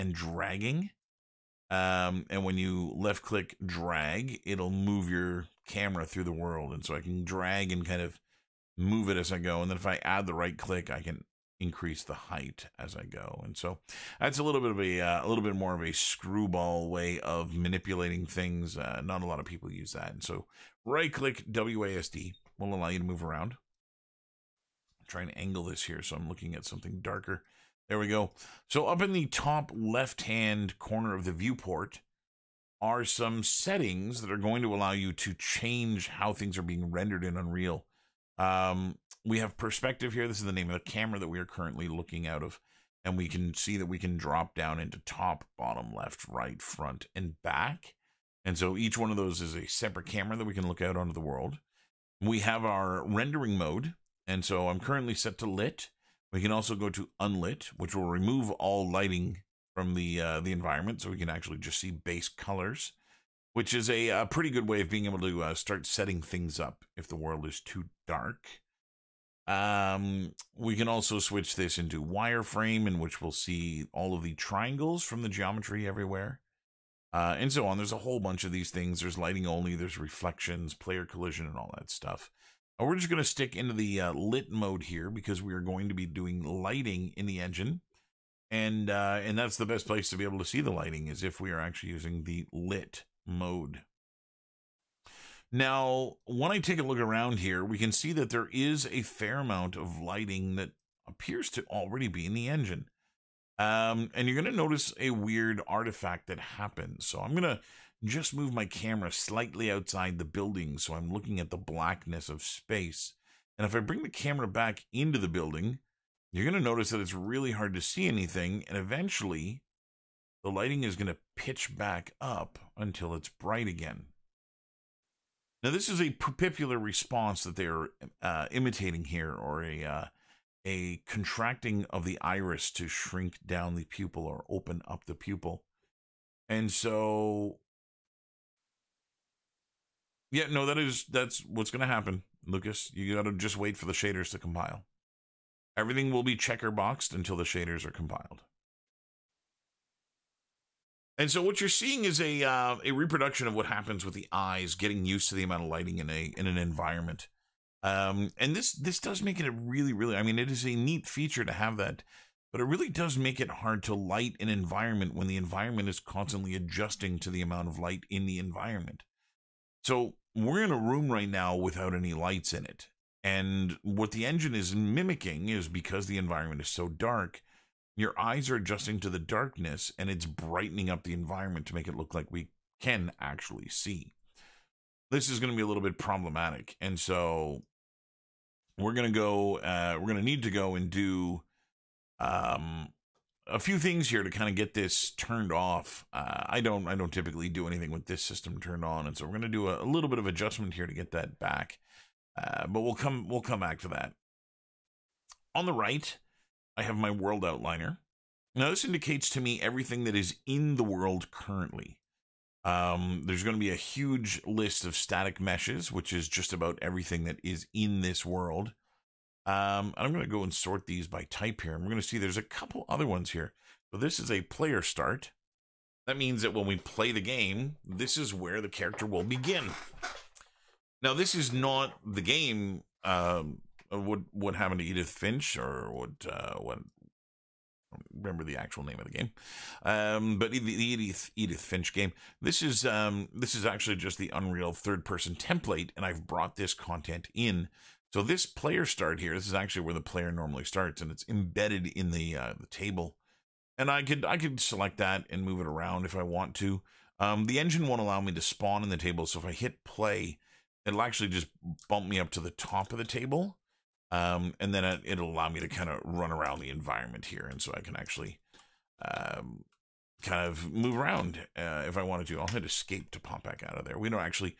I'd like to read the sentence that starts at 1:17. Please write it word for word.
There's a whole bunch of these things.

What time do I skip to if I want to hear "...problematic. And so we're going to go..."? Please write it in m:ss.
3:05.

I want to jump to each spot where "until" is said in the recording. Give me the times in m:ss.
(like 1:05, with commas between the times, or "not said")
2:02, 2:27.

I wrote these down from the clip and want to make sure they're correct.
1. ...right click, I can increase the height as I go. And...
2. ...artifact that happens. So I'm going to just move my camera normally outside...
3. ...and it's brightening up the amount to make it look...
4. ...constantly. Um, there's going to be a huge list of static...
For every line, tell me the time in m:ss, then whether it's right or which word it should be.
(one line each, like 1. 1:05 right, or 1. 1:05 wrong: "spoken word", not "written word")
1. 0:10 right
2. 1:45 wrong: "slightly", not "normally"
3. 2:59 wrong: "environment", not "amount"
4. 3:31 wrong: "currently", not "constantly".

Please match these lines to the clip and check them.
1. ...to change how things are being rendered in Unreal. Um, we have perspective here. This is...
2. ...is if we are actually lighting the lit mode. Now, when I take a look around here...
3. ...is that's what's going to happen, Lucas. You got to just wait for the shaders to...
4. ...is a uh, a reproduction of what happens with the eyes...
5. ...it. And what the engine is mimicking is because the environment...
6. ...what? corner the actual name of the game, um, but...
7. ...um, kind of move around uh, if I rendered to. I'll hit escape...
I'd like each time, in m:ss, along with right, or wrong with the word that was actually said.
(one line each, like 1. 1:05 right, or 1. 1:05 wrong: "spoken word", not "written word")
1. 0:35 right
2. 1:31 wrong: "using", not "lighting"
3. 2:20 right
4. 2:32 right
5. 2:52 right
6. 3:56 wrong: "remember", not "corner"
7. 4:29 wrong: "wanted", not "rendered".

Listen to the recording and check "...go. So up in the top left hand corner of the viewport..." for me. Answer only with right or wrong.
right.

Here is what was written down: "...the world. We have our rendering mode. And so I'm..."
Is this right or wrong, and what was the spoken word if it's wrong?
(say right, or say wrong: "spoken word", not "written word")
right.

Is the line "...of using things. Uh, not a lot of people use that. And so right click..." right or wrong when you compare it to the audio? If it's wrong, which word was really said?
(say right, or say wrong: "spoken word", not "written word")
wrong: "manipulating", not "using".